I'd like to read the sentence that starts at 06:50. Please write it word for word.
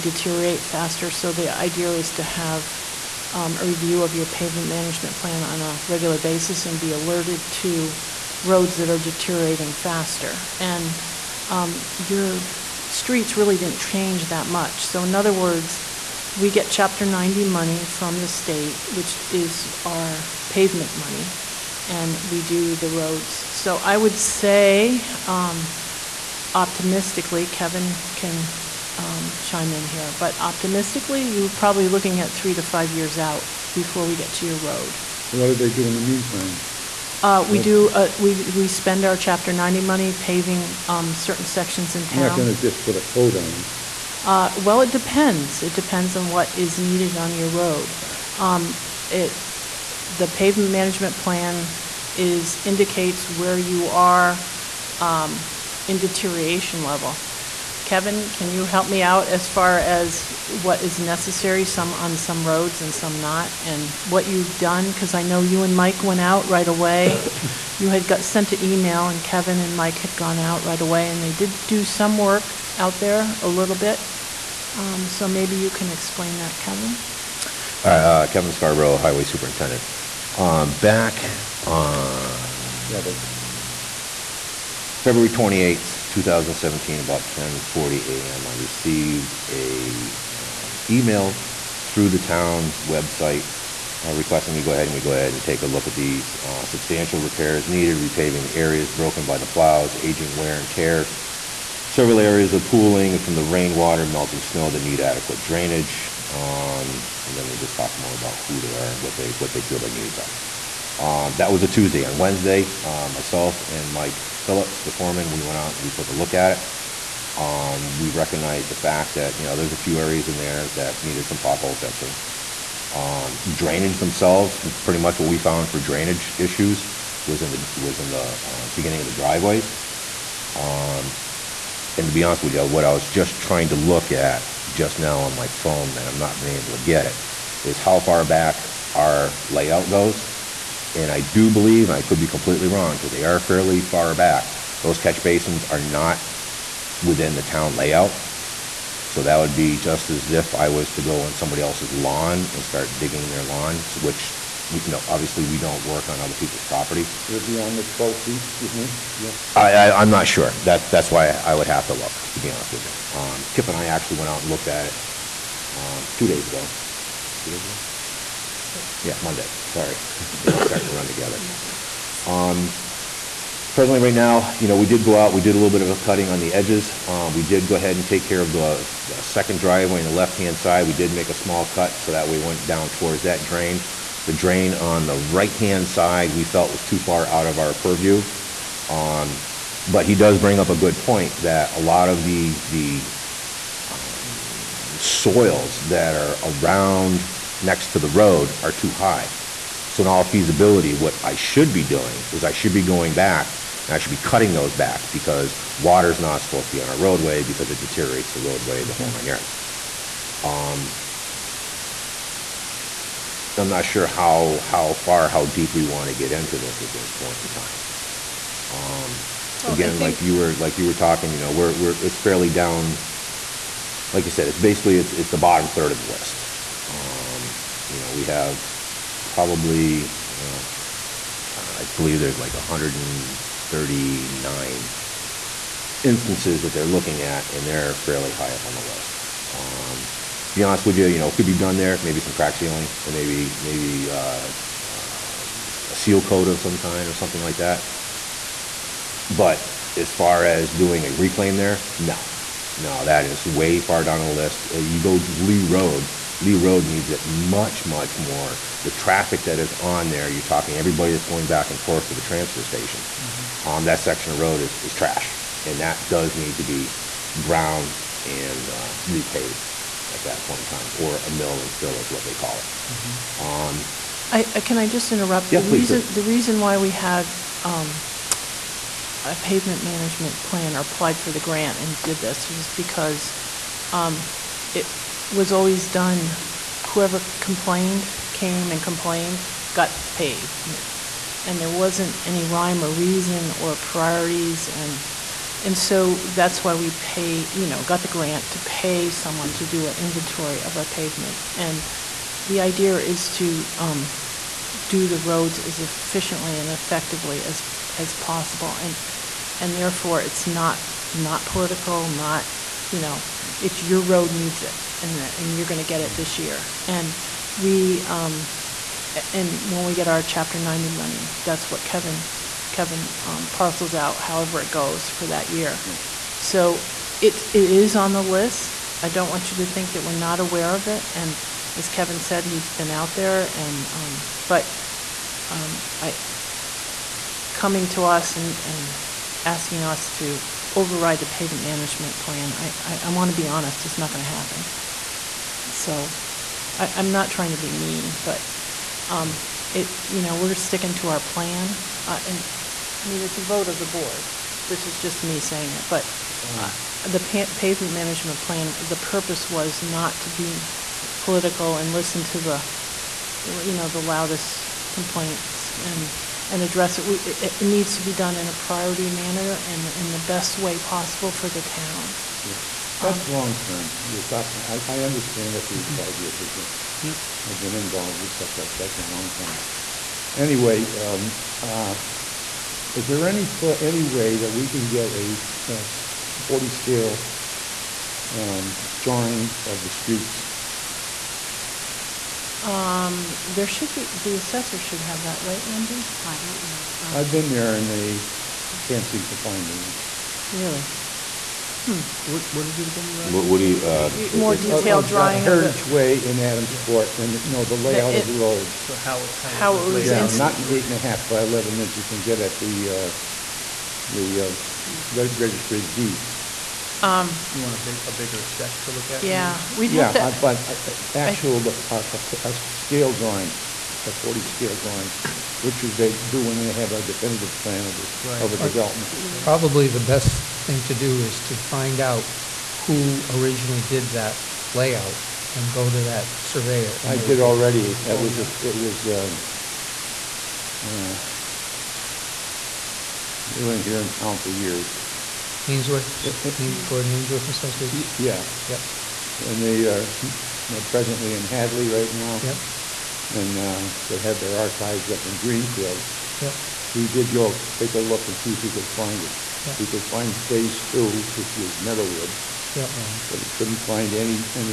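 not eight and a half by 11 inch you can get at the, uh, the uh, Reg- Registry of Deeds.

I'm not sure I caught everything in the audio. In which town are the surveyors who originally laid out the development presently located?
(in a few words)
Hadley.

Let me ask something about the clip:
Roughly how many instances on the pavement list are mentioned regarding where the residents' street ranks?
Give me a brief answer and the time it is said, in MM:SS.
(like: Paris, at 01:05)
139, at 03:52.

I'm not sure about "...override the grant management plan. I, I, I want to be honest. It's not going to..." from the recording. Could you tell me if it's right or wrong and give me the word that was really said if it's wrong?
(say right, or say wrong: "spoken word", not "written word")
wrong: "pavement", not "grant".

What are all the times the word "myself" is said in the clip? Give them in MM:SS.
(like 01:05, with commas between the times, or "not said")
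01:53.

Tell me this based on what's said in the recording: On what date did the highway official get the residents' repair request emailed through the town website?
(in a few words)
February 28, 2017.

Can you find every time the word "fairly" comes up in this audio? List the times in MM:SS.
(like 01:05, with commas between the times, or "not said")
02:23, 03:42, 03:57.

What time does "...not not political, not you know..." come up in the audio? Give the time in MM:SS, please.
05:10.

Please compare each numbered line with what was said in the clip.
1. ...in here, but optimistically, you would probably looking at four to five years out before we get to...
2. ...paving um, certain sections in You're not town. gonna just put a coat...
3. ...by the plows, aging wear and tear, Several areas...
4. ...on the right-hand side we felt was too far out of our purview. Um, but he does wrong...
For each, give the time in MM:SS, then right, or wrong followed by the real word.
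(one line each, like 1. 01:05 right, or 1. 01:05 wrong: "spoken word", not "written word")
1. 00:29 wrong: "three", not "four"
2. 00:40 right
3. 01:39 right
4. 03:04 wrong: "bring", not "wrong".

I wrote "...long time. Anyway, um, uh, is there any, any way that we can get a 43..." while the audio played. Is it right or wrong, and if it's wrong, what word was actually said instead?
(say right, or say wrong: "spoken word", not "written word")
wrong: "40", not "43".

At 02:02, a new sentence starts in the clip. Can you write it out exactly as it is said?
Um, drainage themselves, pretty much what we found for drainage issues was in the was in the uh, beginning of the driveways.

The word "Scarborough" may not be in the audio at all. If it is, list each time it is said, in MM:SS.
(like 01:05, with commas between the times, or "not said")
01:18.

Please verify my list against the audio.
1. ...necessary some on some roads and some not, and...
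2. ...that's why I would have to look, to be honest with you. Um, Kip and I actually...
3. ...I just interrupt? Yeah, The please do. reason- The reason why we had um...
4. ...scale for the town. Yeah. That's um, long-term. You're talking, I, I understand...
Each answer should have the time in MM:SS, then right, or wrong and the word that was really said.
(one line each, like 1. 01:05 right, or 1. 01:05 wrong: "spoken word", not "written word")
1. 01:00 right
2. 02:40 right
3. 04:34 right
4. 06:10 wrong: "possible", not "scale".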